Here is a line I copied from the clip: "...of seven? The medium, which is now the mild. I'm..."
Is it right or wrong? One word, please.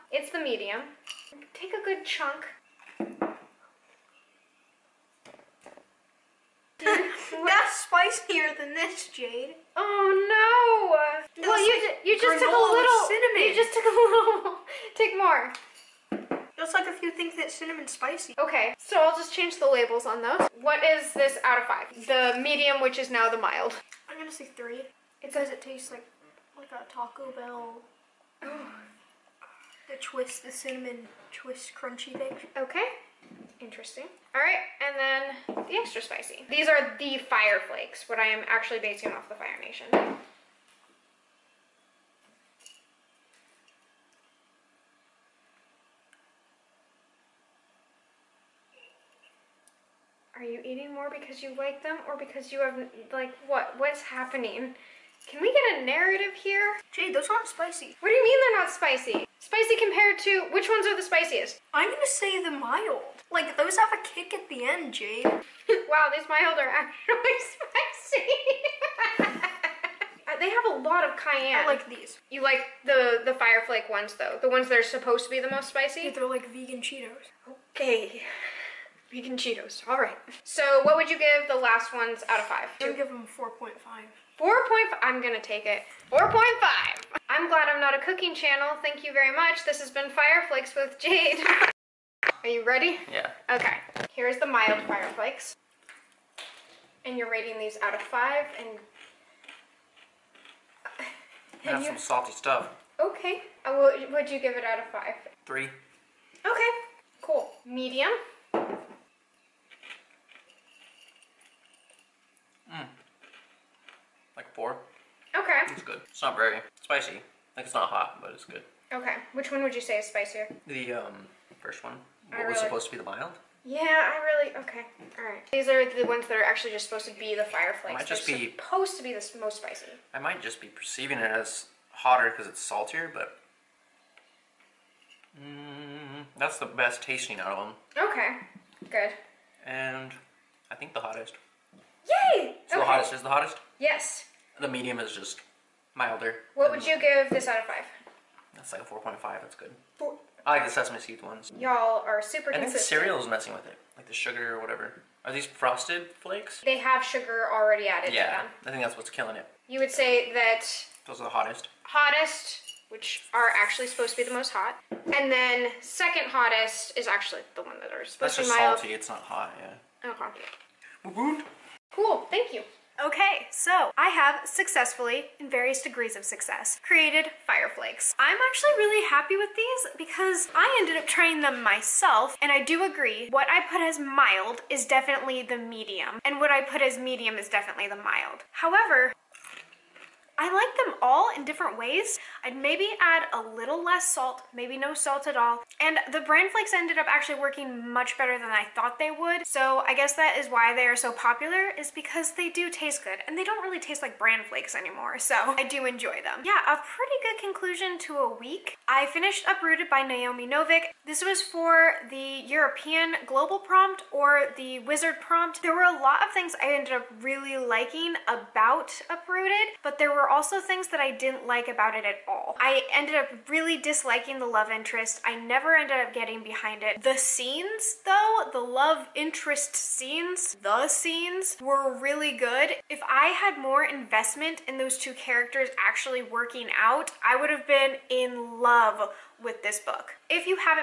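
wrong.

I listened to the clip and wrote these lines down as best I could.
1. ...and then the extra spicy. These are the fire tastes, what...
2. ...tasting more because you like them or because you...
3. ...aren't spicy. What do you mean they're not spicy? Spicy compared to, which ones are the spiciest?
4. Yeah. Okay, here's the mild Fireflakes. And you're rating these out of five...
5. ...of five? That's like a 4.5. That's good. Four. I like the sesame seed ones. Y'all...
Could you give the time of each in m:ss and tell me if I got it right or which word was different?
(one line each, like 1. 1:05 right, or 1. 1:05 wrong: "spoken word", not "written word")
1. 0:34 wrong: "flakes", not "tastes"
2. 0:50 wrong: "eating", not "tasting"
3. 0:57 right
4. 1:33 right
5. 2:27 right.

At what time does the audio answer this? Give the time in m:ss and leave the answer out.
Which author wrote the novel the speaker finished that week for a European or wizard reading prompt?
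3:30.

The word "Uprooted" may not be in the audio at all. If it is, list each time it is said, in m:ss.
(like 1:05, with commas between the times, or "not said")
3:29, 3:39.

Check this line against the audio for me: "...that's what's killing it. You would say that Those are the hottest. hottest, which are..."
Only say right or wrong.
right.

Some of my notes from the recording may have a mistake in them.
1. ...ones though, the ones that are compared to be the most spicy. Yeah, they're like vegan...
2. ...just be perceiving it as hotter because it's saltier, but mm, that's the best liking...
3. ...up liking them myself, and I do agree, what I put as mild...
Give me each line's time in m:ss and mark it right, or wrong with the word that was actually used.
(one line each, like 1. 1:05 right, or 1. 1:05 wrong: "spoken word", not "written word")
1. 1:13 wrong: "supposed", not "compared"
2. 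2:10 wrong: "tasting", not "liking"
3. 3:00 wrong: "trying", not "liking".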